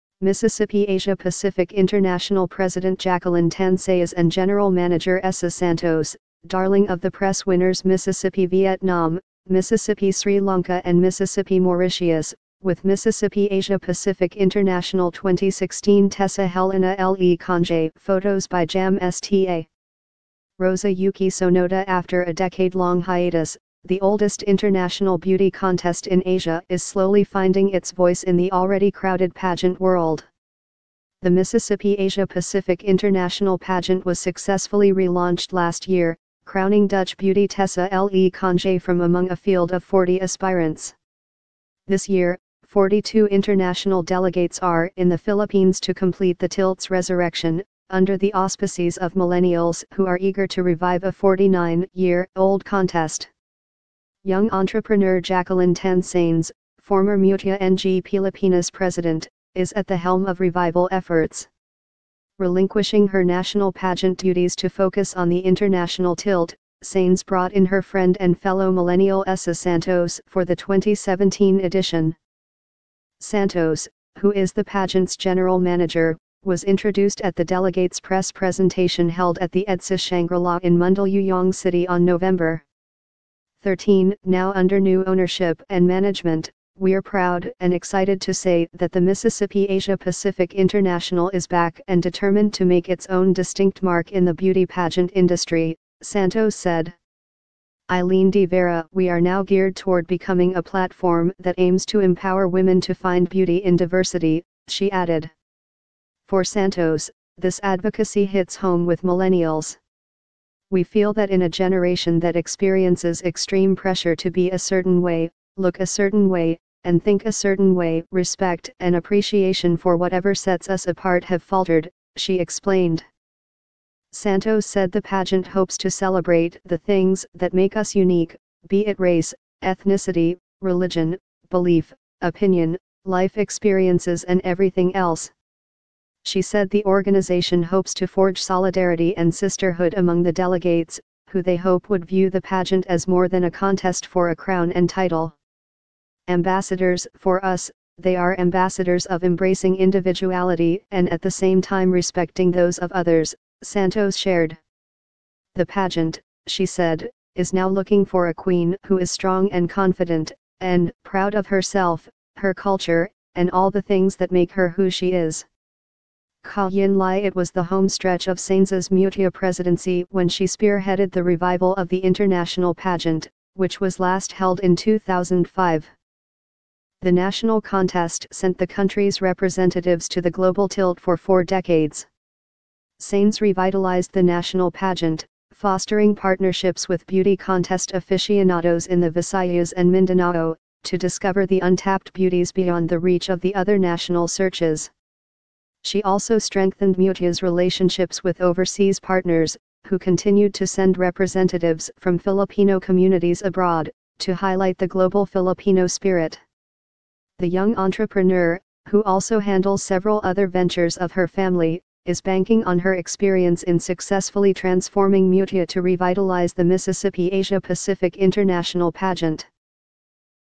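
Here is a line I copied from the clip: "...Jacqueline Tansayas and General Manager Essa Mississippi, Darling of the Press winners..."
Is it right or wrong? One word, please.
wrong.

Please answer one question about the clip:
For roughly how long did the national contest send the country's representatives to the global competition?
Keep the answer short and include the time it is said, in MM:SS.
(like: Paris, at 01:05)
four decades, at 03:01.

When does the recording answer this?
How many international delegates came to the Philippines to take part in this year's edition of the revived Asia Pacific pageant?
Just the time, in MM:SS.
00:42.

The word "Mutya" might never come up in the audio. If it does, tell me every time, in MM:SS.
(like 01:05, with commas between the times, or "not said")
00:57, 02:48, 03:16.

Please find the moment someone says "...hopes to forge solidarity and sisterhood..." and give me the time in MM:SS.
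02:17.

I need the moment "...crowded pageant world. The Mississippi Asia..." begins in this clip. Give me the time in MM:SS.
00:28.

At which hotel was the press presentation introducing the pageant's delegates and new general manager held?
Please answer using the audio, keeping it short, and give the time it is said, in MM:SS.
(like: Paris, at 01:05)
EDSA Shangri-La, at 01:19.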